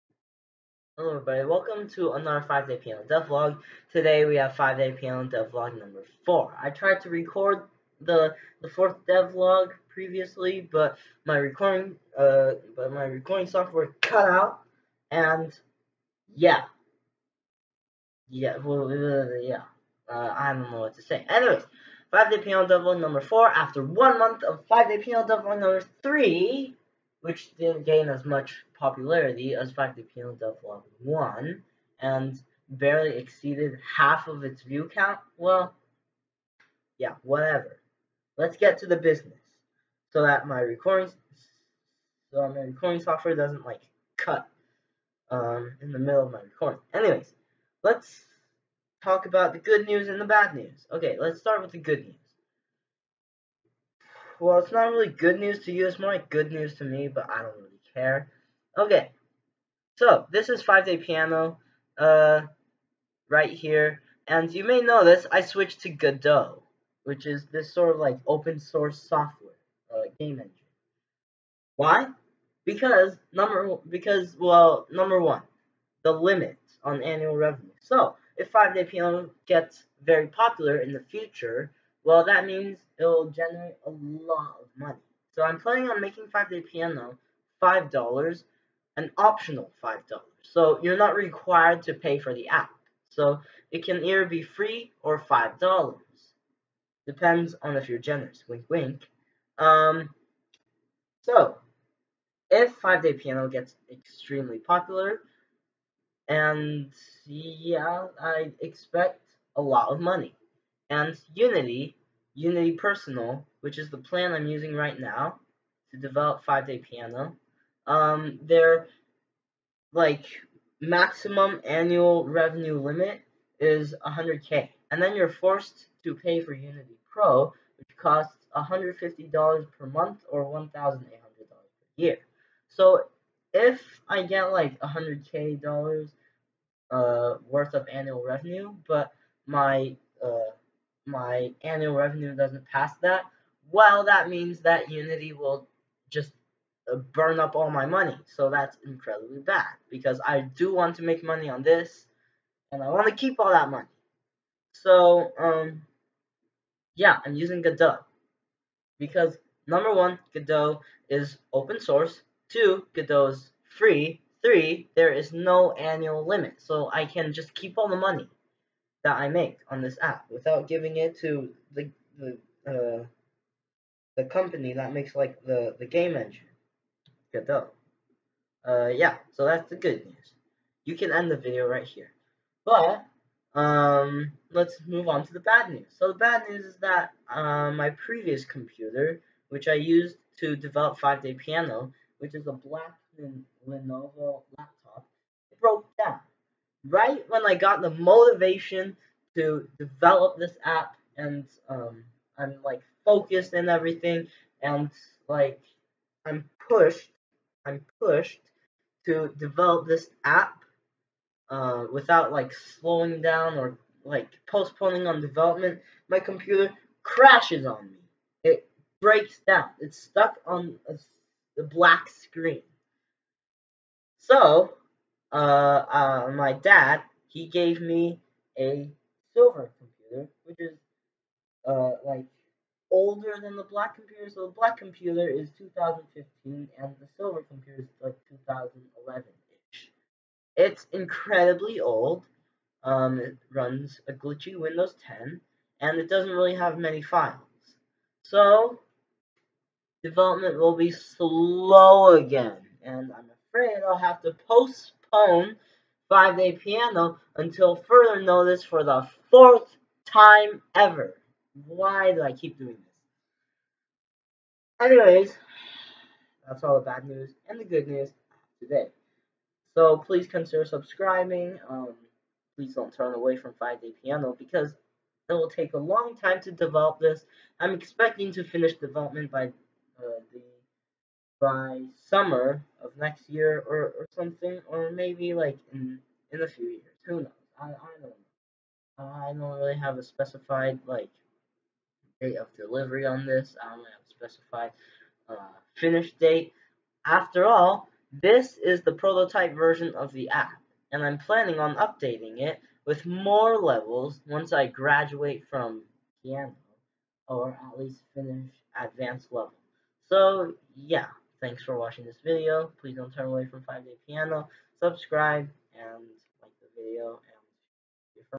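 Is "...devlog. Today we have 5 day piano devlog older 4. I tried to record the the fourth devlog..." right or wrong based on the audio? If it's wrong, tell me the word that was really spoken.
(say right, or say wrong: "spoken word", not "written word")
wrong: "number", not "older".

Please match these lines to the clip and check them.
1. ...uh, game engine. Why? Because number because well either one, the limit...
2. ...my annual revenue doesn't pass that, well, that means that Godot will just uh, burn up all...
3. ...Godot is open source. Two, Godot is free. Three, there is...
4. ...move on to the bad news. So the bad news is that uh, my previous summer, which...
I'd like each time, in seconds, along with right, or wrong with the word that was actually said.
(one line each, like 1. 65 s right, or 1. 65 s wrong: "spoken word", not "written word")
1. 69 s wrong: "number", not "either"
2. 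141 s wrong: "Unity", not "Godot"
3. 160 s right
4. 184 s wrong: "computer", not "summer".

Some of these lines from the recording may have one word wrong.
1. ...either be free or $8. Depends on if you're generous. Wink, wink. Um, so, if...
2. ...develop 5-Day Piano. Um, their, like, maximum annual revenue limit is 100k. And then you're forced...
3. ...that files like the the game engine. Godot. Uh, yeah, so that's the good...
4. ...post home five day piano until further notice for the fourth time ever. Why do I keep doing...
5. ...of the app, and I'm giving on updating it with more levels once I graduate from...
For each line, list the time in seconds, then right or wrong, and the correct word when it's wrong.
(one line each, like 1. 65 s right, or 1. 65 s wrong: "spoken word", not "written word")
1. 94 s wrong: "5", not "8"
2. 115 s right
3. 174 s wrong: "makes", not "files"
4. 254 s right
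5. 299 s wrong: "planning", not "giving".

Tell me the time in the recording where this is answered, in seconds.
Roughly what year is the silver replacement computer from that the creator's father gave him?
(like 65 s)
238 s.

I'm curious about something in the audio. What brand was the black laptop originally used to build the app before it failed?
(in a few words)
Lenovo.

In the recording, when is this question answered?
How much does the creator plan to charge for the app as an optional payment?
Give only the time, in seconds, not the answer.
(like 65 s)
88 s.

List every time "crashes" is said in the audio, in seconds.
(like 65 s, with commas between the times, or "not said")
217 s.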